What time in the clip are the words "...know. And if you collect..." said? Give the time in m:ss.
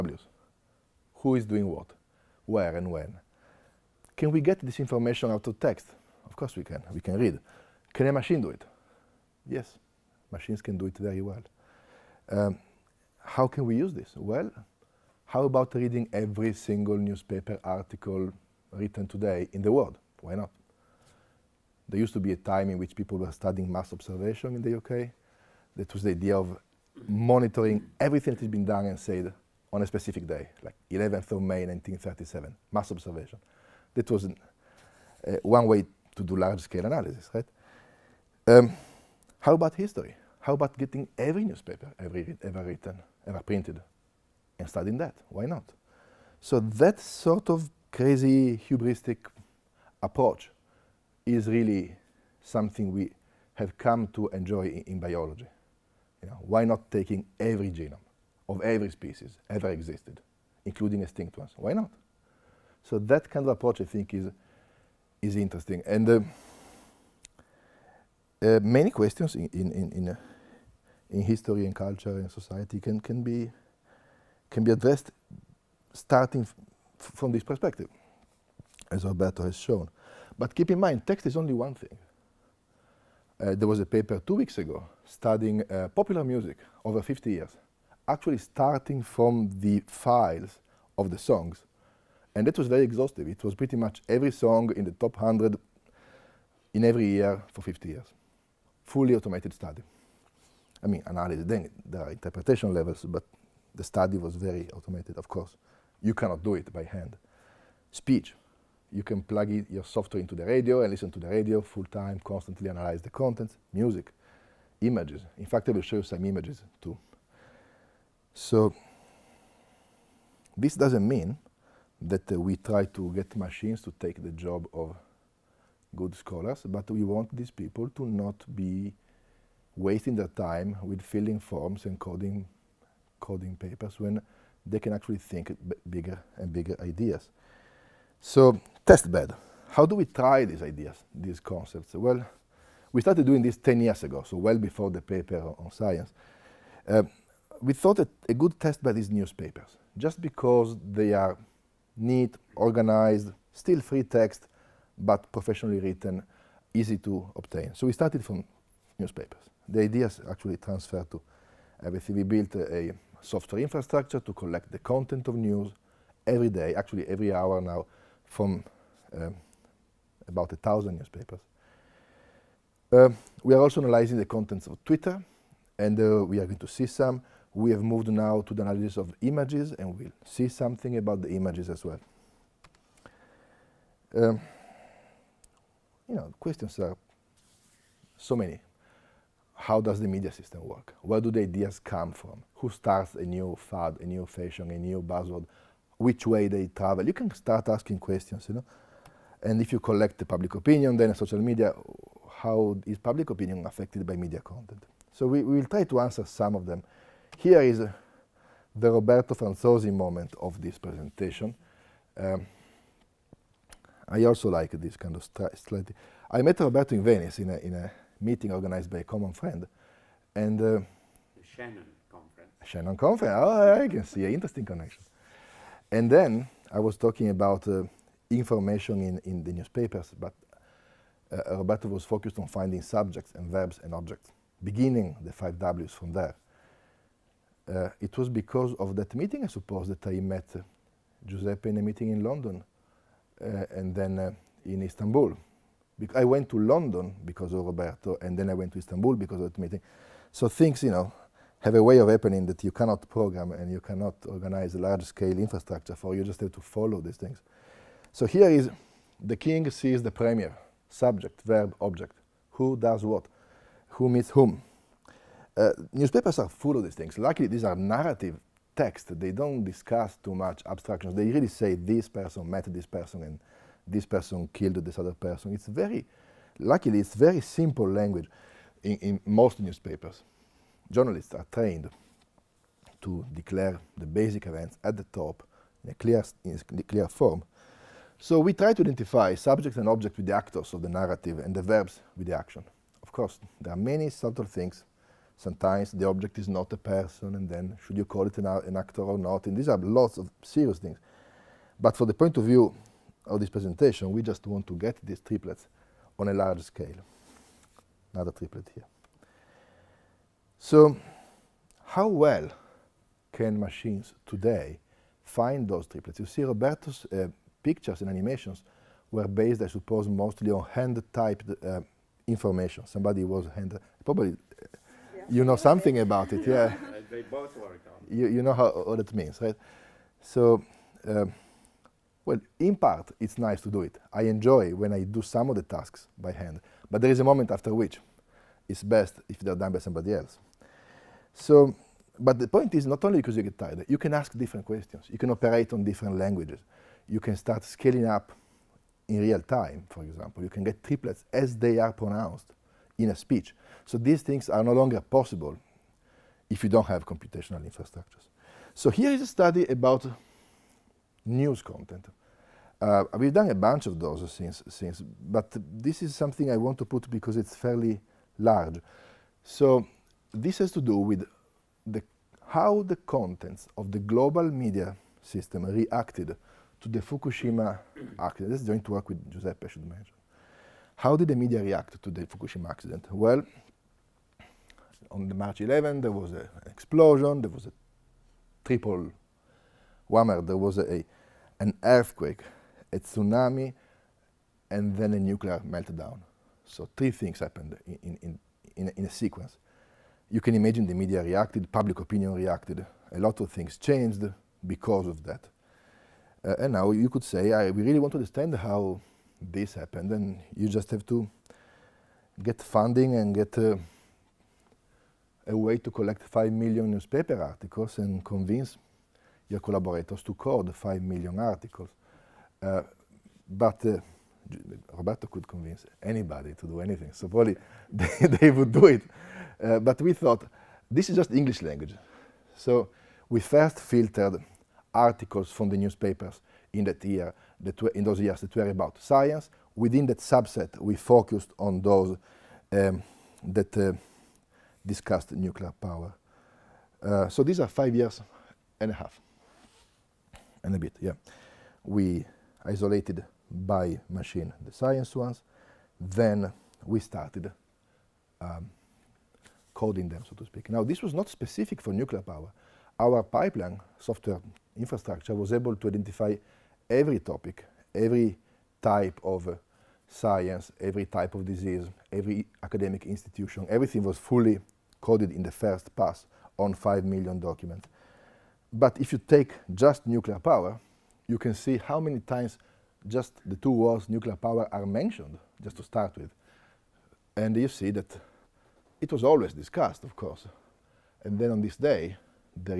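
3:18.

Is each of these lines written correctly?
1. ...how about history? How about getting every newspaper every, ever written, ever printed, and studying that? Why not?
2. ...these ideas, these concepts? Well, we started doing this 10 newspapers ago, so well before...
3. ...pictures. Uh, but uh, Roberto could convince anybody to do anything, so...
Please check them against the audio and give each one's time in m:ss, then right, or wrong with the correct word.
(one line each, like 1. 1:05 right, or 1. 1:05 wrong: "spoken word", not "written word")
1. 0:39 right
2. 2:20 wrong: "years", not "newspapers"
3. 7:01 wrong: "articles", not "pictures".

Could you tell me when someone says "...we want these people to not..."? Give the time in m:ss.
2:06.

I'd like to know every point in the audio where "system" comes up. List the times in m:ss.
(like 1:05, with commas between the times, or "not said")
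3:10, 6:15.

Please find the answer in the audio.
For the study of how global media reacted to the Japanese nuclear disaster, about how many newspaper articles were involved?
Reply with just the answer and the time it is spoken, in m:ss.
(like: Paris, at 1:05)
5 million, at 6:56.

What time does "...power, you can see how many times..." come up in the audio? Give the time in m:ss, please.
8:00.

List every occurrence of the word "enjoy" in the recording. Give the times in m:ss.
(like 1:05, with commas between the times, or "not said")
0:54, 5:34.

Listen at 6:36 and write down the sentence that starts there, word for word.
So three things happened in, in, in, in, a sequence.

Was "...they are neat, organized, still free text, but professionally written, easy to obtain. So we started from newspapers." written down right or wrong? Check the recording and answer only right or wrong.
right.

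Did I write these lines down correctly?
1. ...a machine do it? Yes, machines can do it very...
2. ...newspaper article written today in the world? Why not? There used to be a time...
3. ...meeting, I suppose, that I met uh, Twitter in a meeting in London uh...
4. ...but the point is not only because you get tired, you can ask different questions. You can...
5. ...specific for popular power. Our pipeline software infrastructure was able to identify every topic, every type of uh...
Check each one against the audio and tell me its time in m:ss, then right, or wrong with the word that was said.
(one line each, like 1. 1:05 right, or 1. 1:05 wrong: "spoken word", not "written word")
1. 0:08 right
2. 0:16 right
3. 3:59 wrong: "Giuseppe", not "Twitter"
4. 5:42 right
5. 7:41 wrong: "nuclear", not "popular".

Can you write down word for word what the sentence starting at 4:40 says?
Journalists are trained to declare the basic events at the top in a clear, in a clear form.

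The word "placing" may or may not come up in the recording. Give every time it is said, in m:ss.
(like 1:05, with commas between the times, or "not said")
not said.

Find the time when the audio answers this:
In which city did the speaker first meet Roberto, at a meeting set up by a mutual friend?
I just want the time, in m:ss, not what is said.
3:37.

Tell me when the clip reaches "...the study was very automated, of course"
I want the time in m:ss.
1:43.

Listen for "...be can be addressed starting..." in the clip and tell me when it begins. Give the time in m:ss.
1:13.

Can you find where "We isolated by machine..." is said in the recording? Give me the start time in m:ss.
7:31.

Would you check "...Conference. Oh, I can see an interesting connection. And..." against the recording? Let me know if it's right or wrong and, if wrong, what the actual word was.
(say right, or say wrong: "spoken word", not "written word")
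right.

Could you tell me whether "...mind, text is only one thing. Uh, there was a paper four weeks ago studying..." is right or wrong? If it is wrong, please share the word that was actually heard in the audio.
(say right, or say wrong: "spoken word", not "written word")
wrong: "two", not "four".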